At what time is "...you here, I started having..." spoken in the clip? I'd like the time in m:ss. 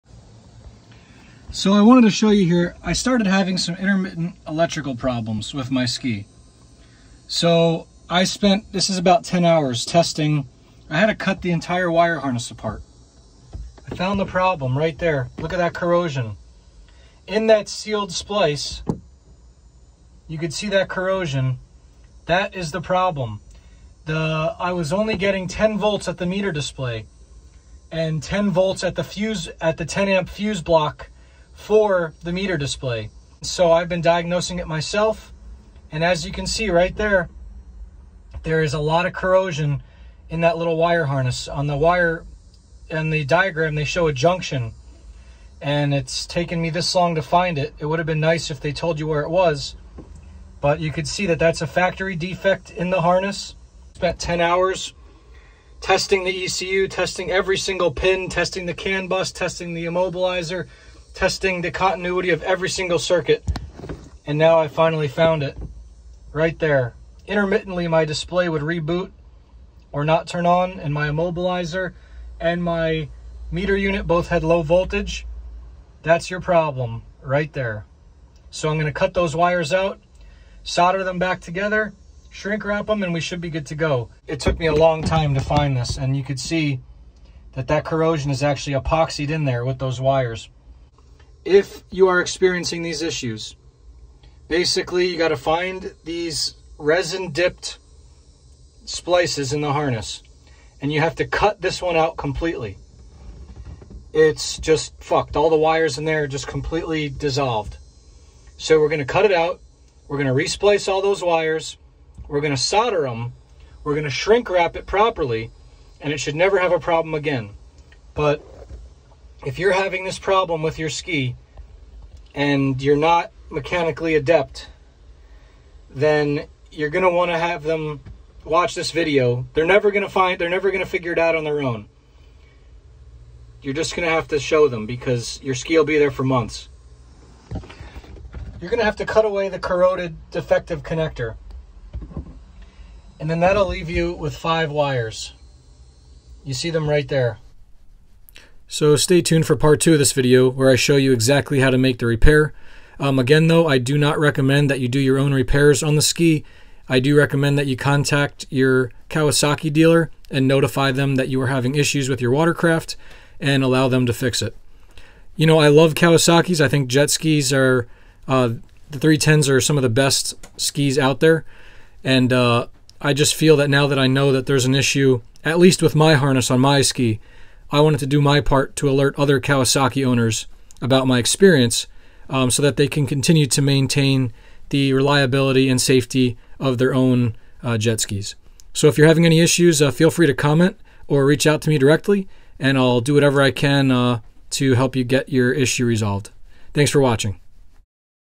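0:02.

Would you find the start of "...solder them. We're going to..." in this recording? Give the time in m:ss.
1:52.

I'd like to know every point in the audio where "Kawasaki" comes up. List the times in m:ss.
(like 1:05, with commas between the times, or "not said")
2:39, 2:45, 2:59.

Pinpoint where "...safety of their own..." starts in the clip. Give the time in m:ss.
3:05.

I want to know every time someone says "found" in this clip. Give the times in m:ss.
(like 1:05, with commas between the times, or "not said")
0:13, 1:05.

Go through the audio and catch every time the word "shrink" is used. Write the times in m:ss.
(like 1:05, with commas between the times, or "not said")
1:22, 1:54.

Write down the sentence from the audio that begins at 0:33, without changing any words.
So I've been diagnosing it myself.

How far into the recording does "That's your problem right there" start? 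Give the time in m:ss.
1:16.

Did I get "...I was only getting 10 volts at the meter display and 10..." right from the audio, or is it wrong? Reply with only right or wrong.
right.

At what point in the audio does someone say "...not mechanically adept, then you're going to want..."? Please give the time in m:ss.
2:02.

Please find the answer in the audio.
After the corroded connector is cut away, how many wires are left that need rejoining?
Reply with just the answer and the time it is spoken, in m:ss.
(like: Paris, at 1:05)
5, at 2:24.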